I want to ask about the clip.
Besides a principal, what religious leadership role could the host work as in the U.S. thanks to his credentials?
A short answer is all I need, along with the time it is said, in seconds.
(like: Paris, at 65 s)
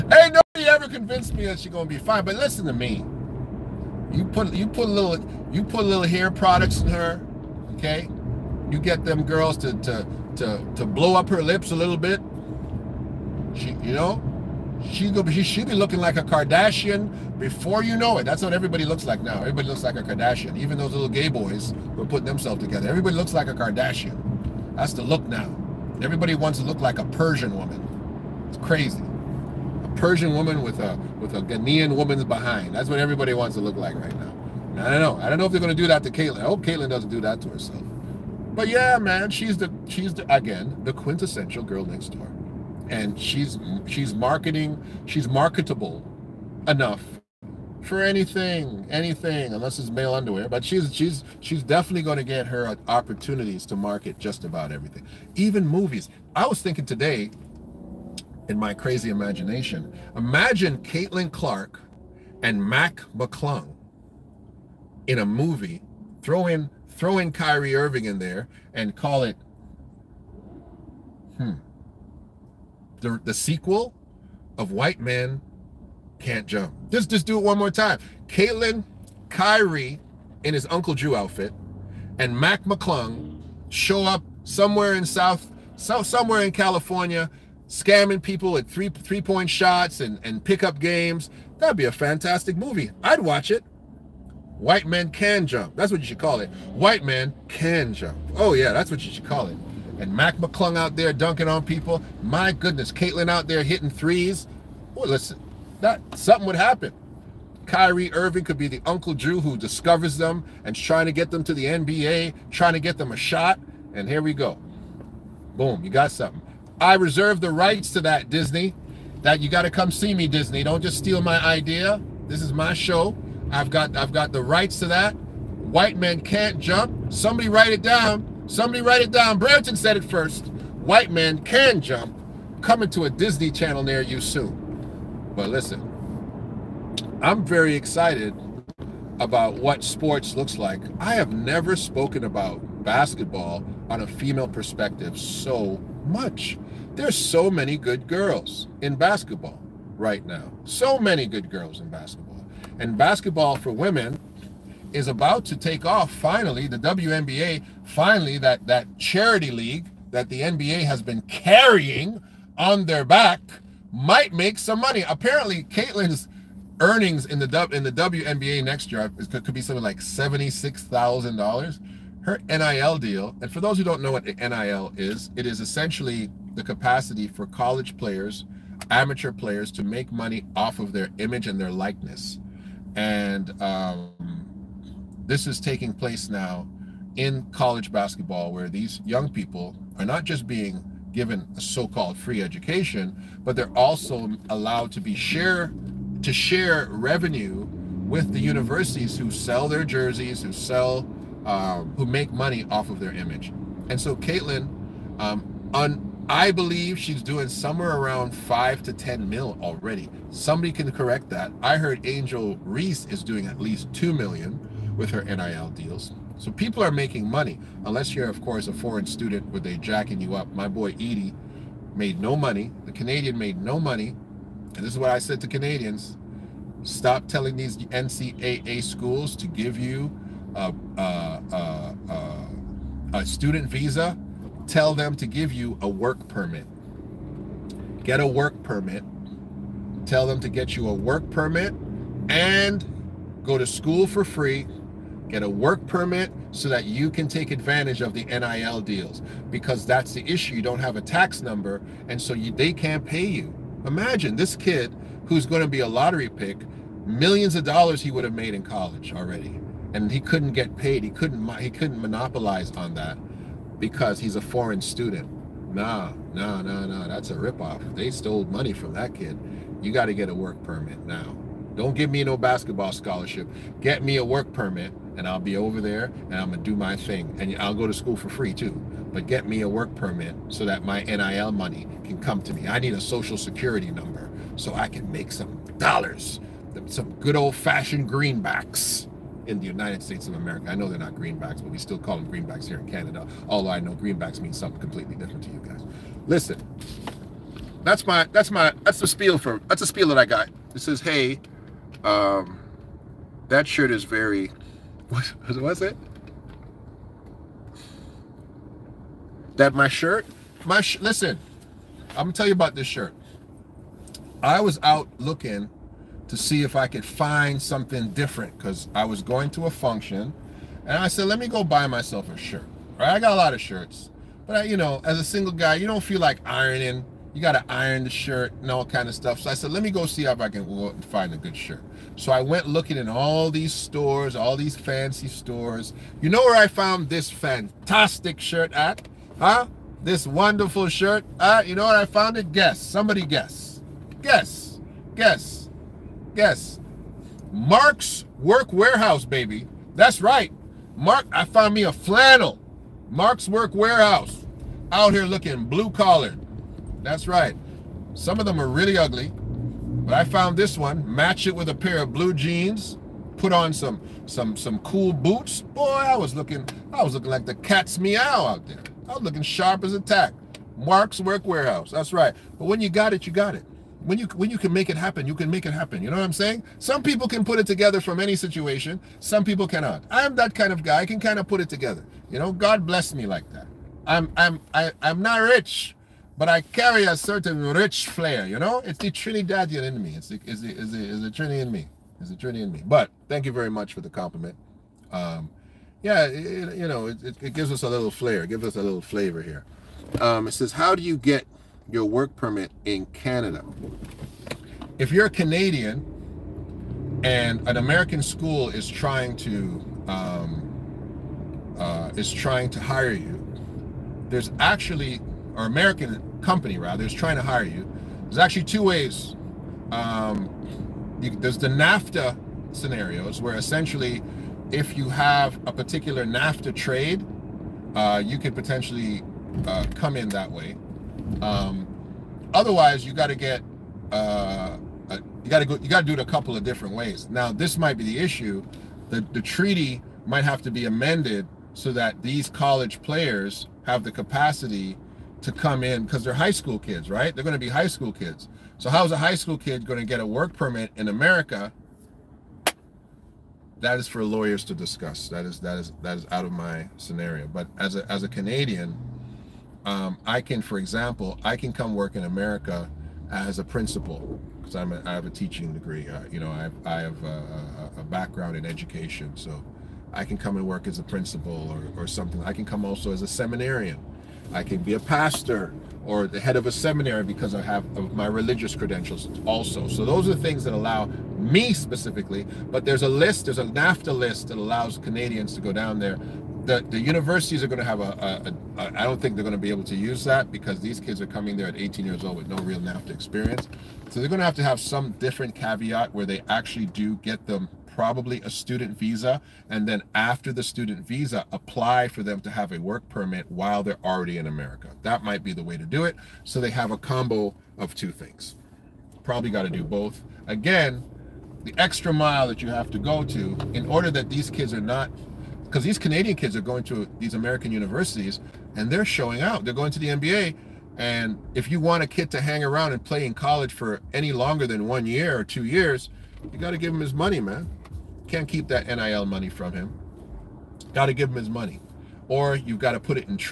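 pastor, at 475 s.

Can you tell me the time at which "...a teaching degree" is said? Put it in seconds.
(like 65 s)
465 s.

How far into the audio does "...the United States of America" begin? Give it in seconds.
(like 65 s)
289 s.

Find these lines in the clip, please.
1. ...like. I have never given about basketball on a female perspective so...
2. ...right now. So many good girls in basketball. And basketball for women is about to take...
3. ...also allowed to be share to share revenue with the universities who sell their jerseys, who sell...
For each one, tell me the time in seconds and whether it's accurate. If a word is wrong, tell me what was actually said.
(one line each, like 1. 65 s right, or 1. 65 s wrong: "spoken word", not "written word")
1. 140 s wrong: "spoken", not "given"
2. 149 s right
3. 193 s right.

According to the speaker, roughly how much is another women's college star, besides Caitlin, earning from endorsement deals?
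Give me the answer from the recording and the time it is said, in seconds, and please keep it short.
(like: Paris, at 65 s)
2 million, at 213 s.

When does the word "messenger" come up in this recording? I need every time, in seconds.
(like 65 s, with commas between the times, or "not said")
not said.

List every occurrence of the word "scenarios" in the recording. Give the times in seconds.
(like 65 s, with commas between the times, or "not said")
422 s, 456 s.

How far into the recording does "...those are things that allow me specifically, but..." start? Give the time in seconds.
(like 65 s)
480 s.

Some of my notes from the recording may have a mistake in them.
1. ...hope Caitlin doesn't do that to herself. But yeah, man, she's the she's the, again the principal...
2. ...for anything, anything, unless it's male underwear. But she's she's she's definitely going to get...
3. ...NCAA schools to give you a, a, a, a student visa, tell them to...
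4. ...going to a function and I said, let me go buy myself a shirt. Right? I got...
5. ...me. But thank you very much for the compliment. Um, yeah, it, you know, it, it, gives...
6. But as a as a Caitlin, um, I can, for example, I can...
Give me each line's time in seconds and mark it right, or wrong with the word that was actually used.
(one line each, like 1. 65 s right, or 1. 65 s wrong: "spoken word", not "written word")
1. 36 s wrong: "quintessential", not "principal"
2. 47 s right
3. 227 s right
4. 319 s right
5. 392 s right
6. 457 s wrong: "Canadian", not "Caitlin".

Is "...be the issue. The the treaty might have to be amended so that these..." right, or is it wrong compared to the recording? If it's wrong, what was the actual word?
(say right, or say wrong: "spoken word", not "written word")
right.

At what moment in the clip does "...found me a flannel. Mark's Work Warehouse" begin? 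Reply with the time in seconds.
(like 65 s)
351 s.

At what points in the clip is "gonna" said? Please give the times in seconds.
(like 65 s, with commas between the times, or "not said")
1 s, 276 s, 312 s.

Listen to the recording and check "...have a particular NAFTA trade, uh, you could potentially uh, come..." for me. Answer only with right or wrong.
right.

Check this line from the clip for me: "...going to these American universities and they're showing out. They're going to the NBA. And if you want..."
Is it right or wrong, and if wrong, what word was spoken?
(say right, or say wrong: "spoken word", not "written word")
right.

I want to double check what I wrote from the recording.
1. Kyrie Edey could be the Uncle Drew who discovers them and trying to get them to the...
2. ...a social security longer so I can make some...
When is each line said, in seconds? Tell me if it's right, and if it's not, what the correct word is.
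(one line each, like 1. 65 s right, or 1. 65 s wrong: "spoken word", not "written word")
1. 107 s wrong: "Irving", not "Edey"
2. 282 s wrong: "number", not "longer".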